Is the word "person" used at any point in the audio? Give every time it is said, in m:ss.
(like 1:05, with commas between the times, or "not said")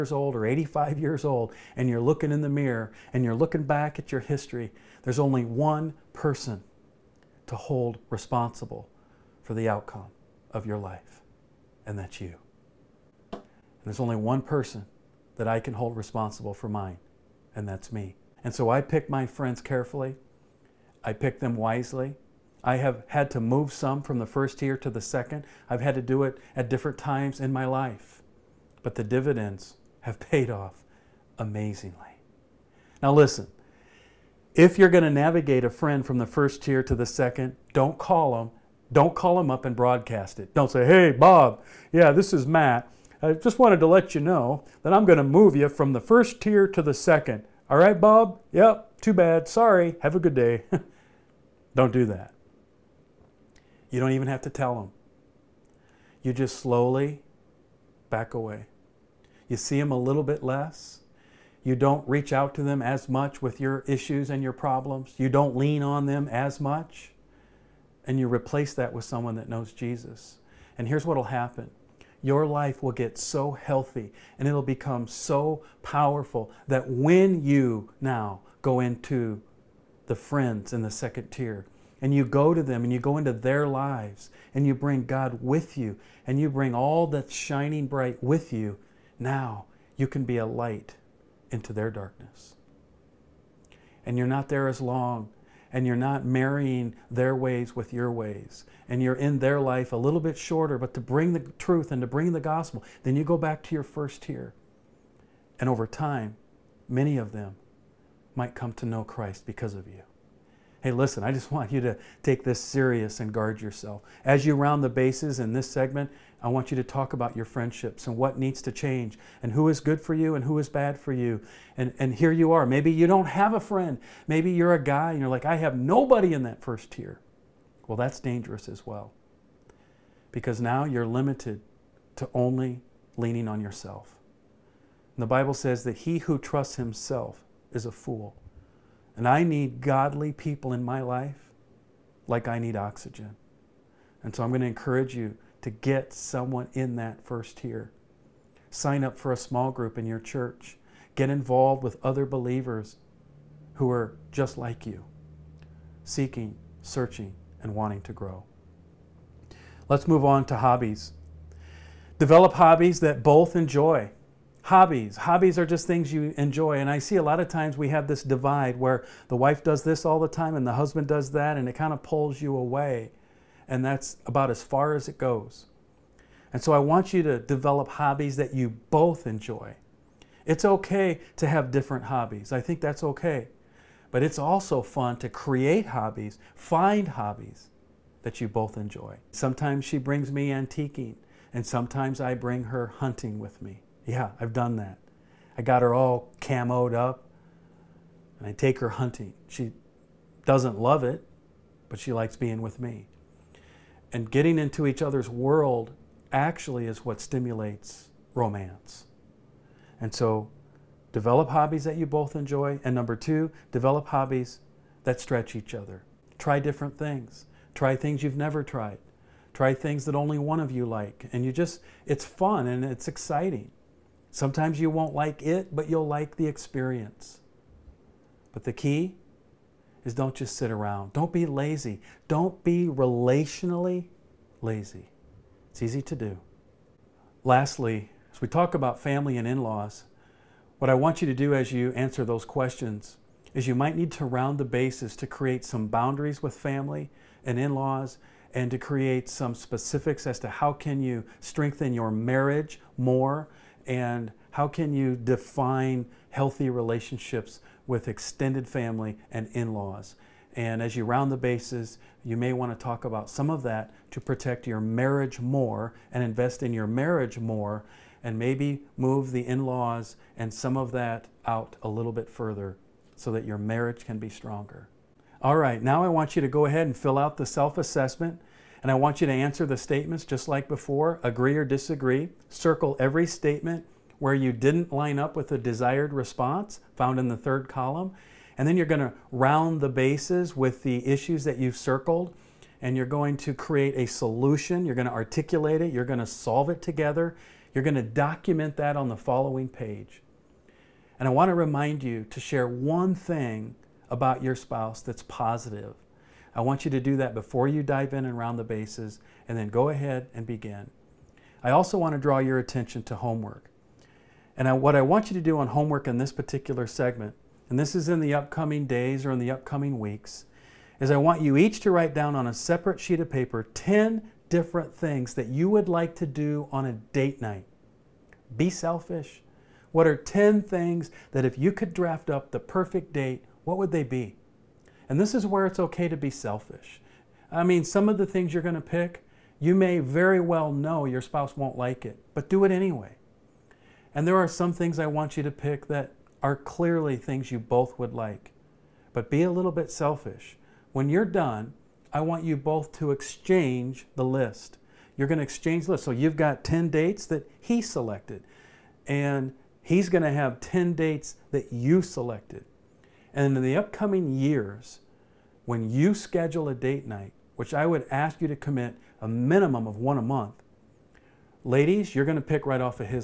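0:06, 0:14.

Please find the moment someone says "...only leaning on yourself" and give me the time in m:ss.
2:12.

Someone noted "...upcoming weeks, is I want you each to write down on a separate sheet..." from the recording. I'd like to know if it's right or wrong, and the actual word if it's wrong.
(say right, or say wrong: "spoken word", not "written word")
right.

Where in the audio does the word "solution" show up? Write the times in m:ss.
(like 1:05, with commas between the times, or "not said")
4:54.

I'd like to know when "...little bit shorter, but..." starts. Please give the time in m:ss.
1:39.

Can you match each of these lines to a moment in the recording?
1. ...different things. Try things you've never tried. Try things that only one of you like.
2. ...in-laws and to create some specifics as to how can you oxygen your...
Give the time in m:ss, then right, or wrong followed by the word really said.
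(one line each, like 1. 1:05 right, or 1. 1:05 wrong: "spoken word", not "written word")
1. 3:36 right
2. 4:07 wrong: "strengthen", not "oxygen".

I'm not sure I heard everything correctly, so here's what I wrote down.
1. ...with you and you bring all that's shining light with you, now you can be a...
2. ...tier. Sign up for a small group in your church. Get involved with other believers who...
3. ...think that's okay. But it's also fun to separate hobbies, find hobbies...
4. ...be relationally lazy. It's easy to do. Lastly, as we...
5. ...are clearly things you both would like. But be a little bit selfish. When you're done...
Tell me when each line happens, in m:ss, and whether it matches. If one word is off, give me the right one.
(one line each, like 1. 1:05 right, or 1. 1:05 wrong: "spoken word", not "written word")
1. 1:25 wrong: "bright", not "light"
2. 2:27 right
3. 3:02 wrong: "create", not "separate"
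4. 3:52 right
5. 5:46 right.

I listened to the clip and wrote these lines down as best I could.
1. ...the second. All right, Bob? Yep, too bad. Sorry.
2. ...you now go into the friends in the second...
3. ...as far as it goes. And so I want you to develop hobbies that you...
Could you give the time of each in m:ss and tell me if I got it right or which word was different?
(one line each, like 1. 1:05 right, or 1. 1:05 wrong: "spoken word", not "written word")
1. 0:46 right
2. 1:17 right
3. 2:54 right.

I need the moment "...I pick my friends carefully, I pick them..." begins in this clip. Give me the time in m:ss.
0:18.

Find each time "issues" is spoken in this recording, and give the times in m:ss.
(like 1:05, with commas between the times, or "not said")
1:03, 4:51.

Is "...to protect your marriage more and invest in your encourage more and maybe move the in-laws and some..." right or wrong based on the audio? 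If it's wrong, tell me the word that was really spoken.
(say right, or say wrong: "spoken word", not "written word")
wrong: "marriage", not "encourage".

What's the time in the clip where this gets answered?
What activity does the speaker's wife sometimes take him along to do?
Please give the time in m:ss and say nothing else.
3:10.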